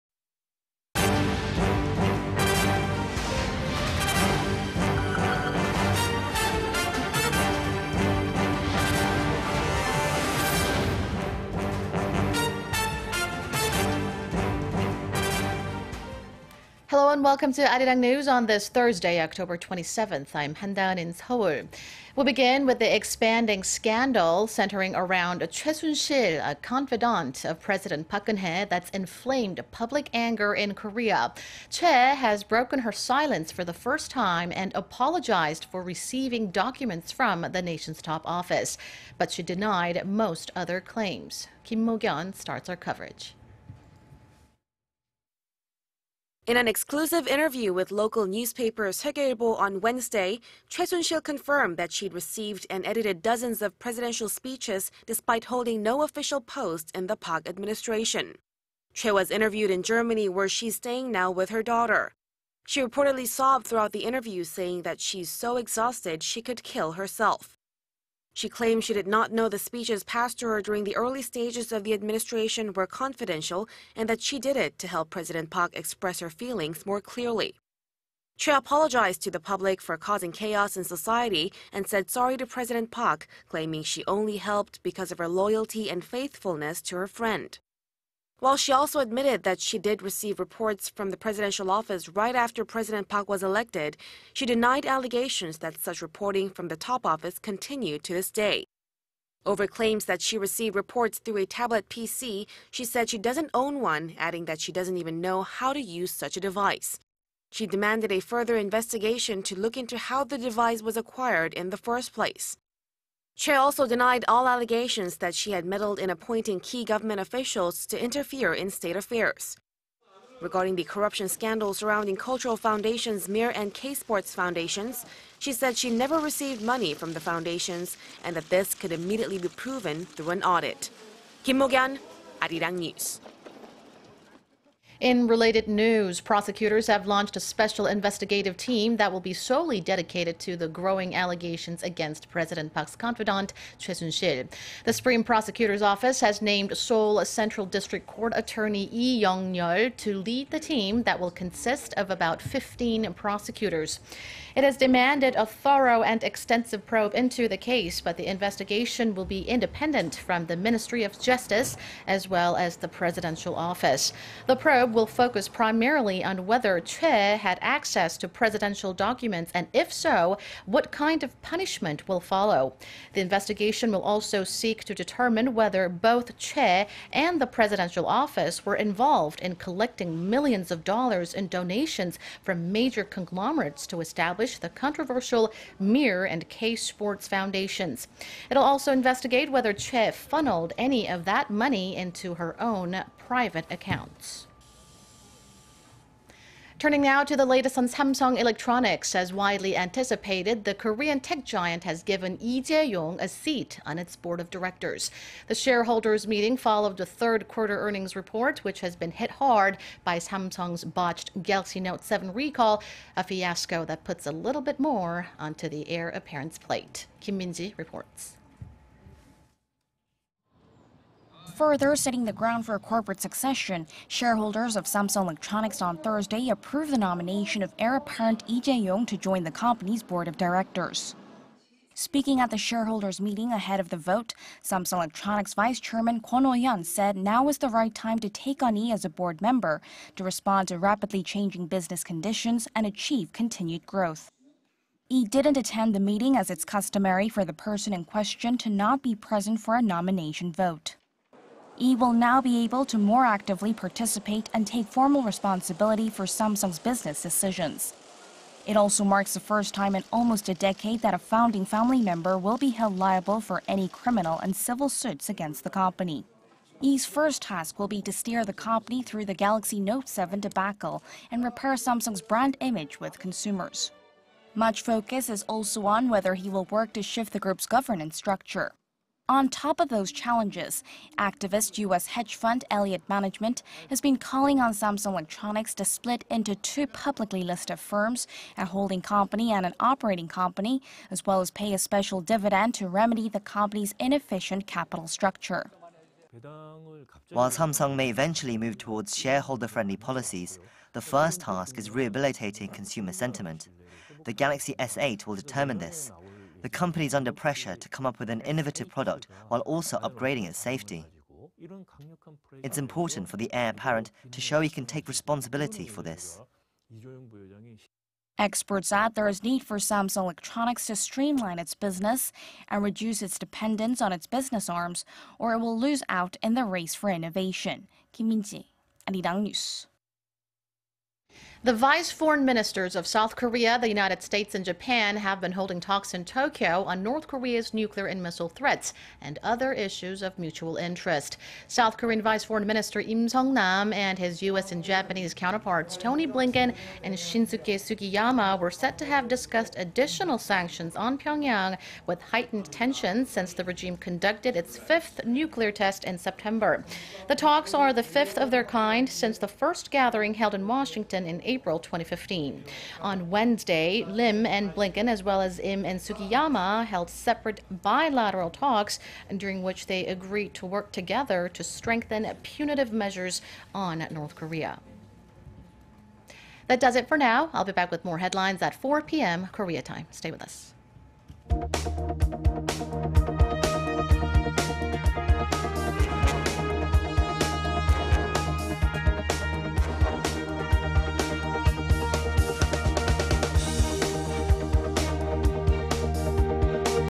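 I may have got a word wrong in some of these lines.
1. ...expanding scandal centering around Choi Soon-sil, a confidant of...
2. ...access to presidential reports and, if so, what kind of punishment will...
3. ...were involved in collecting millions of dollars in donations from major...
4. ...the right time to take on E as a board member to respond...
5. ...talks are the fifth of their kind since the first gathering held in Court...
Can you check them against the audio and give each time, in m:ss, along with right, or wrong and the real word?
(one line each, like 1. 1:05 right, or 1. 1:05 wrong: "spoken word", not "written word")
1. 0:22 right
2. 2:47 wrong: "documents", not "reports"
3. 2:58 right
4. 3:57 right
5. 5:57 wrong: "Washington", not "Court".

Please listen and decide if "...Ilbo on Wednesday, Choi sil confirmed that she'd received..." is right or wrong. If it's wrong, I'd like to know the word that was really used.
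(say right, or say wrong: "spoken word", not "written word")
right.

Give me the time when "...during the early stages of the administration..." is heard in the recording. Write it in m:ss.
1:10.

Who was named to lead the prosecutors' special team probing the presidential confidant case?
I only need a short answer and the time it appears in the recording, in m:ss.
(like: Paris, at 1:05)
Yi Young-yeol, at 2:28.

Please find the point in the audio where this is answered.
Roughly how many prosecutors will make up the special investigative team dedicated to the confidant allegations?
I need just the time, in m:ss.
2:32.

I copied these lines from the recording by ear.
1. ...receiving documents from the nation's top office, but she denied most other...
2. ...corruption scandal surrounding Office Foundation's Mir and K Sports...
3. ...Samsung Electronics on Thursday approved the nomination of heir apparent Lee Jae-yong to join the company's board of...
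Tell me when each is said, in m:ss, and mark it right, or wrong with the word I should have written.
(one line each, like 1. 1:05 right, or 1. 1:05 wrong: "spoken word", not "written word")
1. 0:35 right
2. 2:00 wrong: "Cultural", not "Office"
3. 3:44 right.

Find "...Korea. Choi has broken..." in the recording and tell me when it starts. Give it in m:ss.
0:30.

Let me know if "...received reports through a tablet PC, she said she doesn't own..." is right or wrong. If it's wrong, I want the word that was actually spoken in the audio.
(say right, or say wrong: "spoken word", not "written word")
right.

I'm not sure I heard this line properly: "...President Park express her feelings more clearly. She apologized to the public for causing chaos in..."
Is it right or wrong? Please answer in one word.
right.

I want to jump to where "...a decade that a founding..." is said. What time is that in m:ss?
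4:20.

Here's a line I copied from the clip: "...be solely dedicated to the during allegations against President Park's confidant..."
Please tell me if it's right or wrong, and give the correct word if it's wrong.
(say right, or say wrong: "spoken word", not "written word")
wrong: "growing", not "during".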